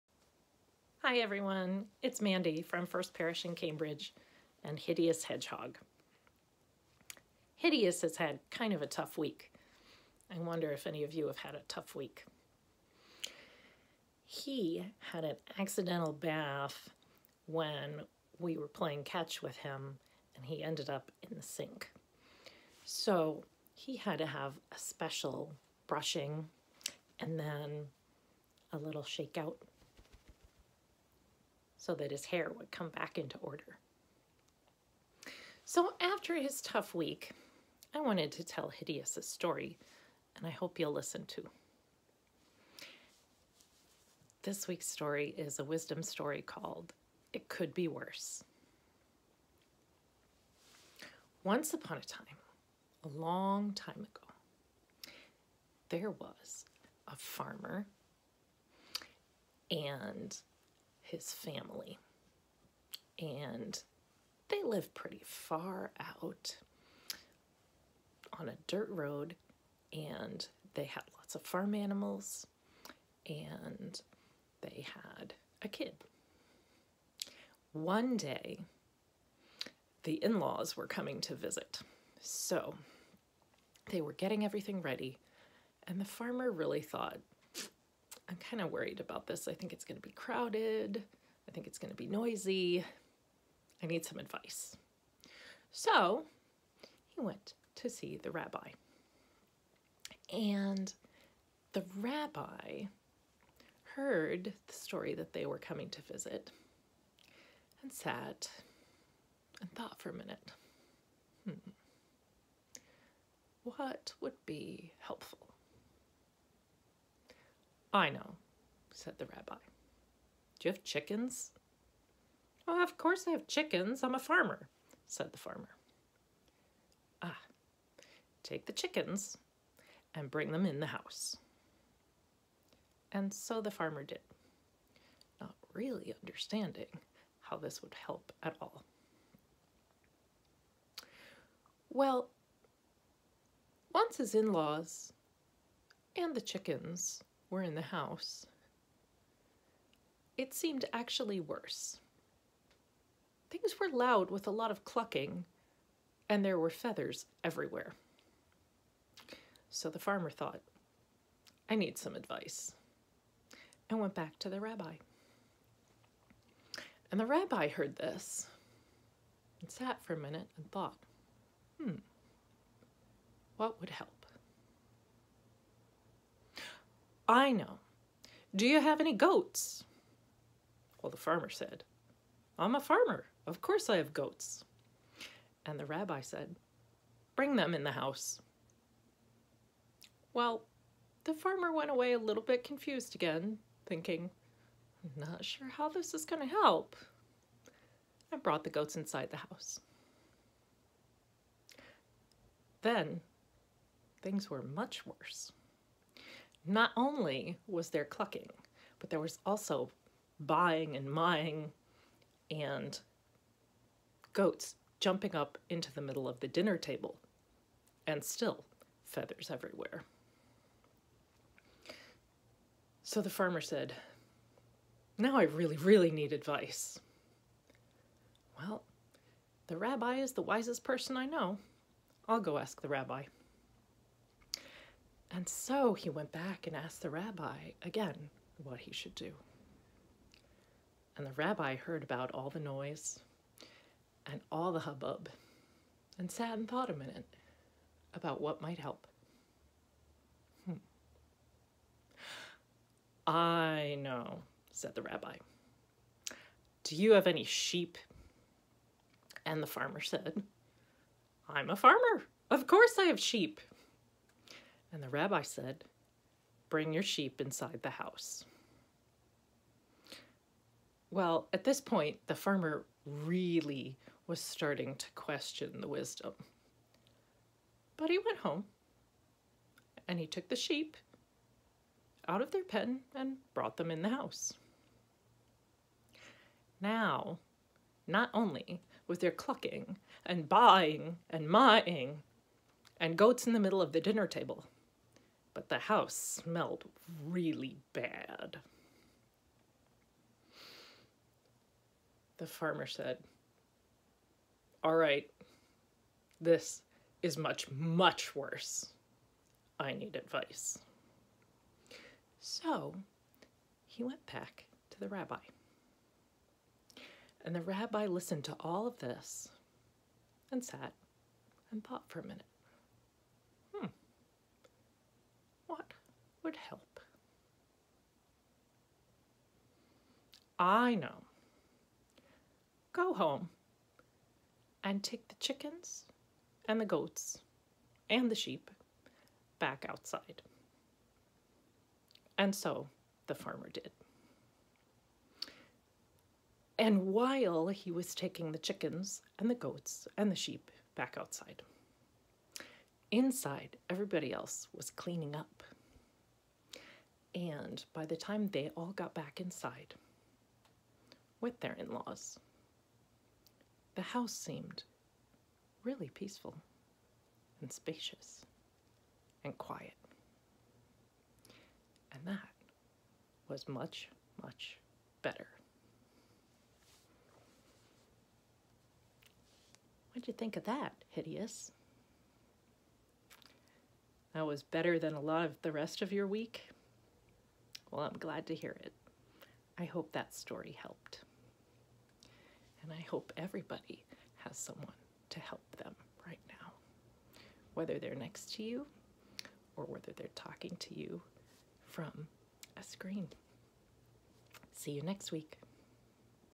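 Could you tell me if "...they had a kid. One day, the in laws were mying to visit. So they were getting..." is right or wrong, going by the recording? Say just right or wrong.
wrong.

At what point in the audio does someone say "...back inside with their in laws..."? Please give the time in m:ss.
5:59.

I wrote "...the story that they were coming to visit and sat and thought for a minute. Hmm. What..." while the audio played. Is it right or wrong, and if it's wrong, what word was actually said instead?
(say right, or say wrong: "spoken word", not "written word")
right.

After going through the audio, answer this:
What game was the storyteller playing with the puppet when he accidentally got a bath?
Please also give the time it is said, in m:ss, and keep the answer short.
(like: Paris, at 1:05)
Playing catch, at 0:18.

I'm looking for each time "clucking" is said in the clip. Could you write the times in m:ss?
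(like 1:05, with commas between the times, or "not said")
2:34, 3:28, 4:49.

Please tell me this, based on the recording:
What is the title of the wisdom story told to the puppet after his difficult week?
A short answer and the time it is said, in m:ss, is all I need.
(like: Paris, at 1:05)
It Could Be Worse, at 0:47.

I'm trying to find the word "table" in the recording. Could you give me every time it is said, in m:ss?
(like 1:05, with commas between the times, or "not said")
3:36, 4:54.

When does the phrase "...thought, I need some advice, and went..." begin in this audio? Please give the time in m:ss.
2:40.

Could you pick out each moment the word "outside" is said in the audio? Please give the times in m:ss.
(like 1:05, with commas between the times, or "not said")
5:39, 5:51.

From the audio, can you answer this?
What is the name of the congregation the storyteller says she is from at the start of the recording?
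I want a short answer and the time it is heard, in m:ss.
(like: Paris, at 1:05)
First Parish in Cambridge, at 0:02.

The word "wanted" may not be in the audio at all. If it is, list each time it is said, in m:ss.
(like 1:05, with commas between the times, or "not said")
0:38.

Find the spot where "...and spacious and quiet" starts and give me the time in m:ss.
6:07.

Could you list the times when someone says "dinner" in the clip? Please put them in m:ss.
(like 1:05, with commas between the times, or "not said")
3:36, 4:54.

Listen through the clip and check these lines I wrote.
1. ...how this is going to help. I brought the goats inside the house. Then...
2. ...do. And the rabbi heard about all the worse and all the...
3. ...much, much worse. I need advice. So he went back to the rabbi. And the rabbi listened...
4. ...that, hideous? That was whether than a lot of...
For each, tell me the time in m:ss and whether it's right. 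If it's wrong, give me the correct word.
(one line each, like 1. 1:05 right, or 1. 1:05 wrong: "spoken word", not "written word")
1. 3:15 right
2. 3:59 wrong: "noise", not "worse"
3. 5:07 right
4. 6:20 wrong: "better", not "whether".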